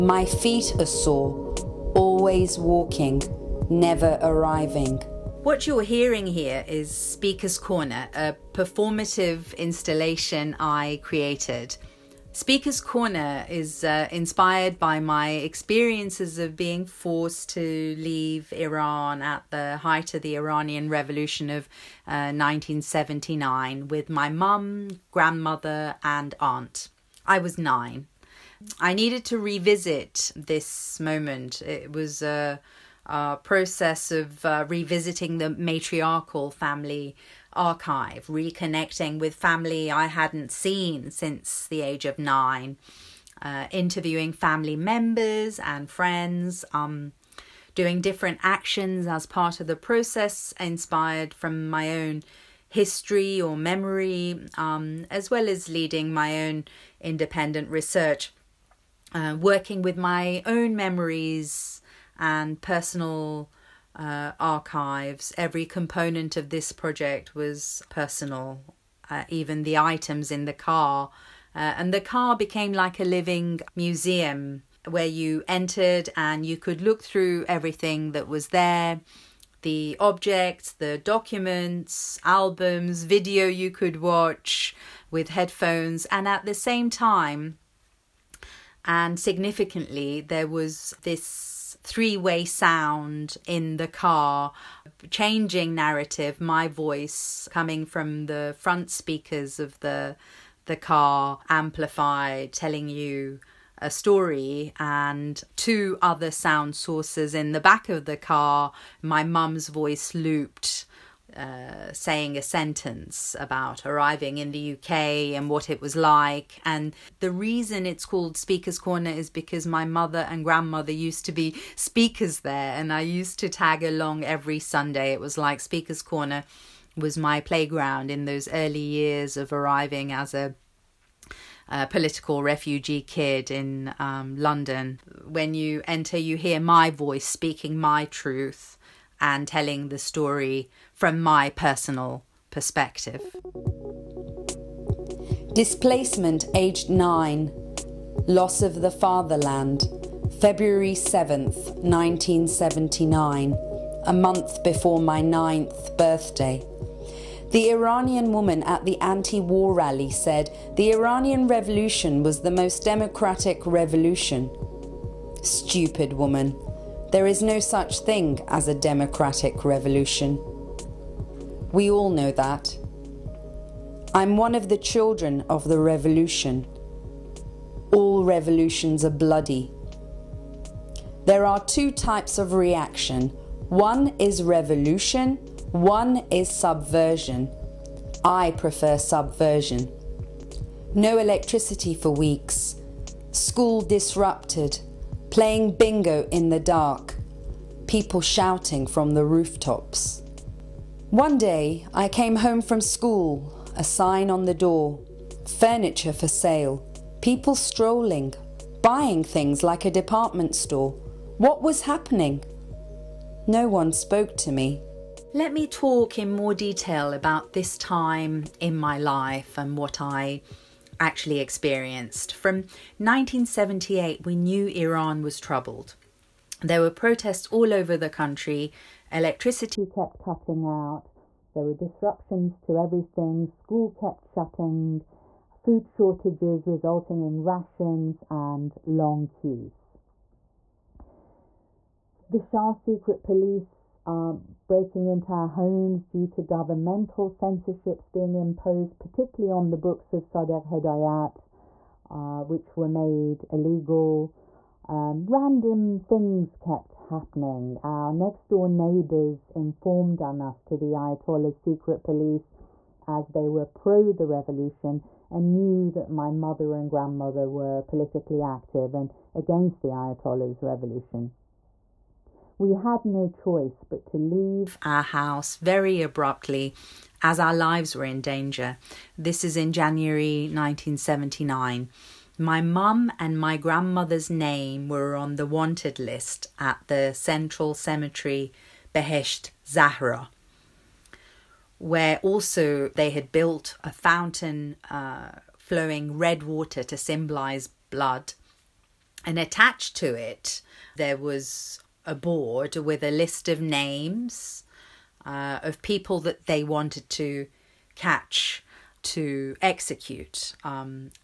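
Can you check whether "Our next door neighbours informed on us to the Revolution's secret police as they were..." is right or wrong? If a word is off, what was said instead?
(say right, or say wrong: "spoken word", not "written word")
wrong: "Ayatollah", not "Revolution".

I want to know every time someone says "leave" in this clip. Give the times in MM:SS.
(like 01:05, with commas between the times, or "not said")
00:17, 04:34.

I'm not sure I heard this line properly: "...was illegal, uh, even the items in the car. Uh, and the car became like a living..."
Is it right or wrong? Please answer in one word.
wrong.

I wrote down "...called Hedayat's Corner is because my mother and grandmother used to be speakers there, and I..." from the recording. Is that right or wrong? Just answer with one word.
wrong.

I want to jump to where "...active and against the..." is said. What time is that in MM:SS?
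04:28.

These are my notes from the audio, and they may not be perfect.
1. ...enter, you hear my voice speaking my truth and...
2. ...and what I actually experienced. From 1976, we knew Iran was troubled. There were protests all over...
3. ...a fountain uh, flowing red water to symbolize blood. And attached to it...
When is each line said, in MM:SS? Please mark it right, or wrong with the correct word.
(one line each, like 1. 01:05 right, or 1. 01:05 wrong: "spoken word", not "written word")
1. 02:15 right
2. 03:39 wrong: "1978", not "1976"
3. 04:53 right.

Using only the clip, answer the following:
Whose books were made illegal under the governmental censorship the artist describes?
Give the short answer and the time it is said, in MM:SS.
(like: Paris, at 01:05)
Sadegh Hedayat, at 04:10.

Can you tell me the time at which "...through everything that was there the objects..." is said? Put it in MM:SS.
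01:17.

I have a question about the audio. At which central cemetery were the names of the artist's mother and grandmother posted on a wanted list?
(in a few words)
Behesht Zahra.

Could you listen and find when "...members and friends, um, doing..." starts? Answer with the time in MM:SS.
00:44.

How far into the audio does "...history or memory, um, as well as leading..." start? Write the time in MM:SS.
00:52.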